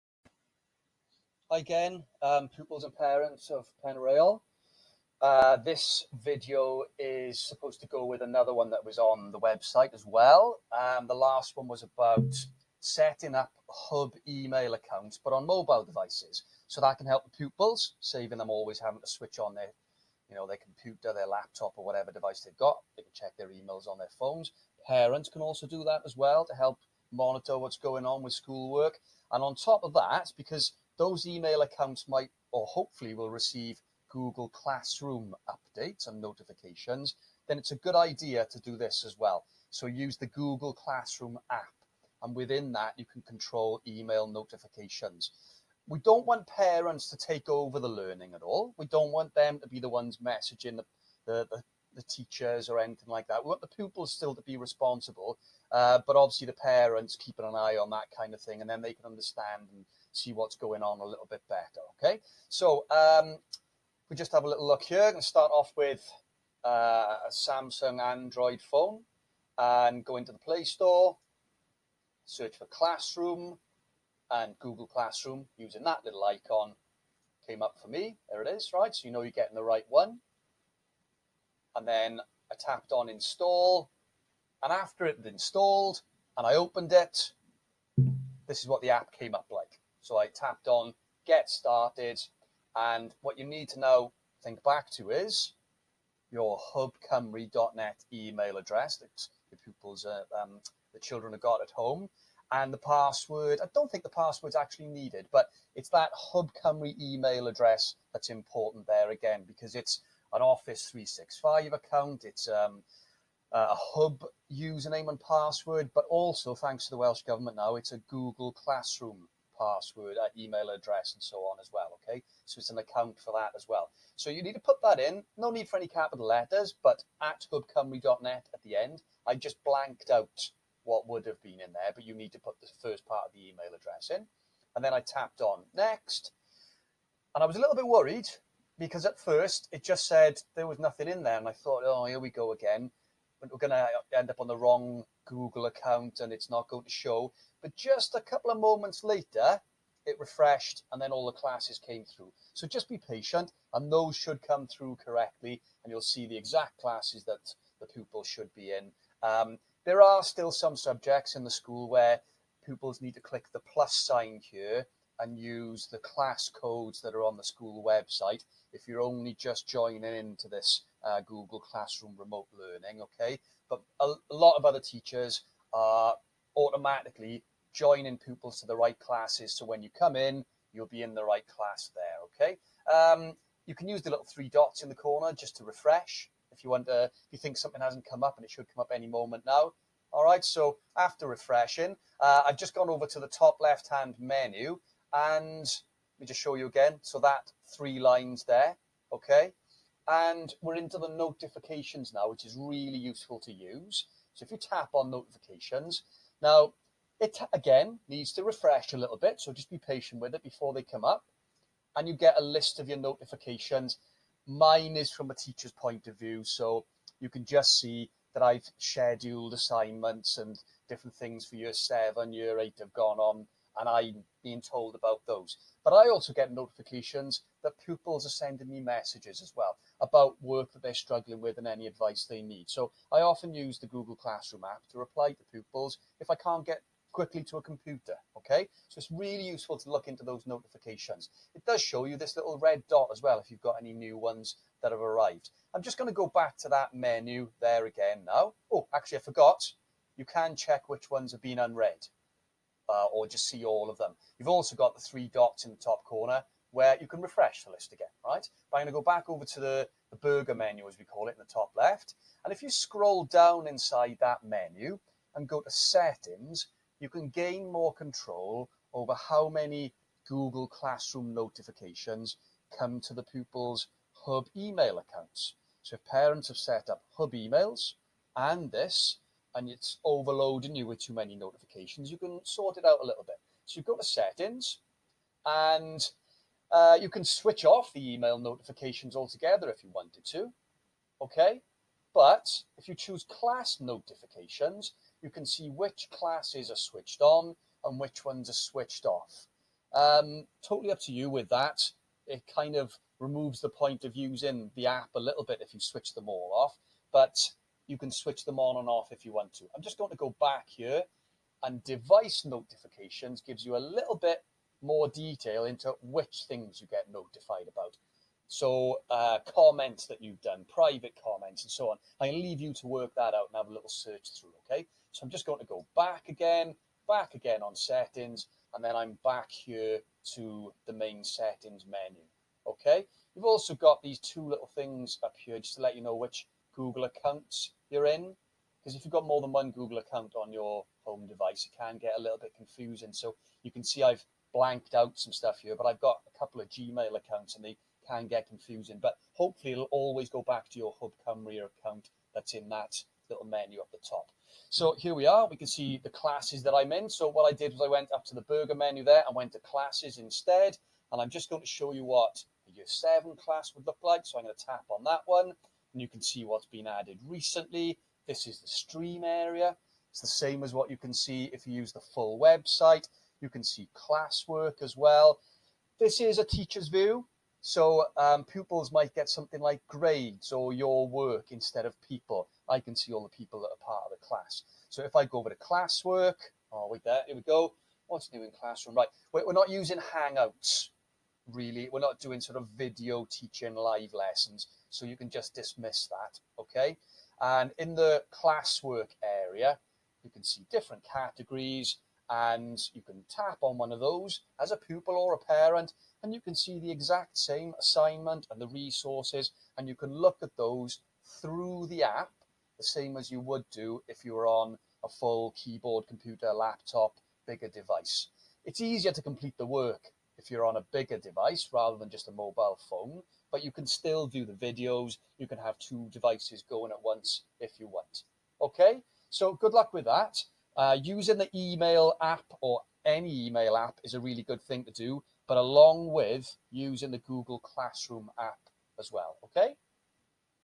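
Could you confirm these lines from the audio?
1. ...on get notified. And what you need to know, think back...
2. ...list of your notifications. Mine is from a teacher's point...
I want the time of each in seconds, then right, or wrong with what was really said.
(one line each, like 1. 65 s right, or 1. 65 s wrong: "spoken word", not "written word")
1. 90 s wrong: "started", not "notified"
2. 212 s right.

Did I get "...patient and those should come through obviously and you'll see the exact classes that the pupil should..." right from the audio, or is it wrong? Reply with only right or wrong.
wrong.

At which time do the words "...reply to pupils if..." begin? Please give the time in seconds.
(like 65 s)
234 s.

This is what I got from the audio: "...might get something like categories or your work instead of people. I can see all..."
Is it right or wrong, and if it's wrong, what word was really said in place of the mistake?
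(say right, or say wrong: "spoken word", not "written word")
wrong: "grades", not "categories".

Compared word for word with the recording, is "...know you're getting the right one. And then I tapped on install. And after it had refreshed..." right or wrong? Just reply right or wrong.
wrong.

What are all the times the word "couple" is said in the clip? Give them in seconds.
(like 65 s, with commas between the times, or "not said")
148 s, 346 s.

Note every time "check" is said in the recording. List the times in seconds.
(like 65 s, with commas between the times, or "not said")
23 s, 250 s.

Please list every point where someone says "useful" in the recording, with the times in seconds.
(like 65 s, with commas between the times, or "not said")
202 s, 239 s.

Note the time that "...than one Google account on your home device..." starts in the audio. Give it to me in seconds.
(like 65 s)
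339 s.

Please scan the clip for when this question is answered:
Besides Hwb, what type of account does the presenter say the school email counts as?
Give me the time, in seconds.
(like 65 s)
110 s.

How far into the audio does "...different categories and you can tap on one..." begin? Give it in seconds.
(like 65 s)
400 s.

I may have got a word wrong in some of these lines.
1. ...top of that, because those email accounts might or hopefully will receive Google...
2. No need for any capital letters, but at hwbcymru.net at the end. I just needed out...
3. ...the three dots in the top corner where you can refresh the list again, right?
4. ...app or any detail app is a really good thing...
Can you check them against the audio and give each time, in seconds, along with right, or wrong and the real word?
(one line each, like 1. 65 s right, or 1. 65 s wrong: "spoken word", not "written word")
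1. 29 s right
2. 125 s wrong: "blanked", not "needed"
3. 254 s right
4. 432 s wrong: "email", not "detail".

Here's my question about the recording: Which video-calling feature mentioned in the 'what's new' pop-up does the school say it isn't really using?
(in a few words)
Hangouts.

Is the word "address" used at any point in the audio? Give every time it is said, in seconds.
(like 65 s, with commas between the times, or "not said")
98 s, 107 s, 120 s, 133 s.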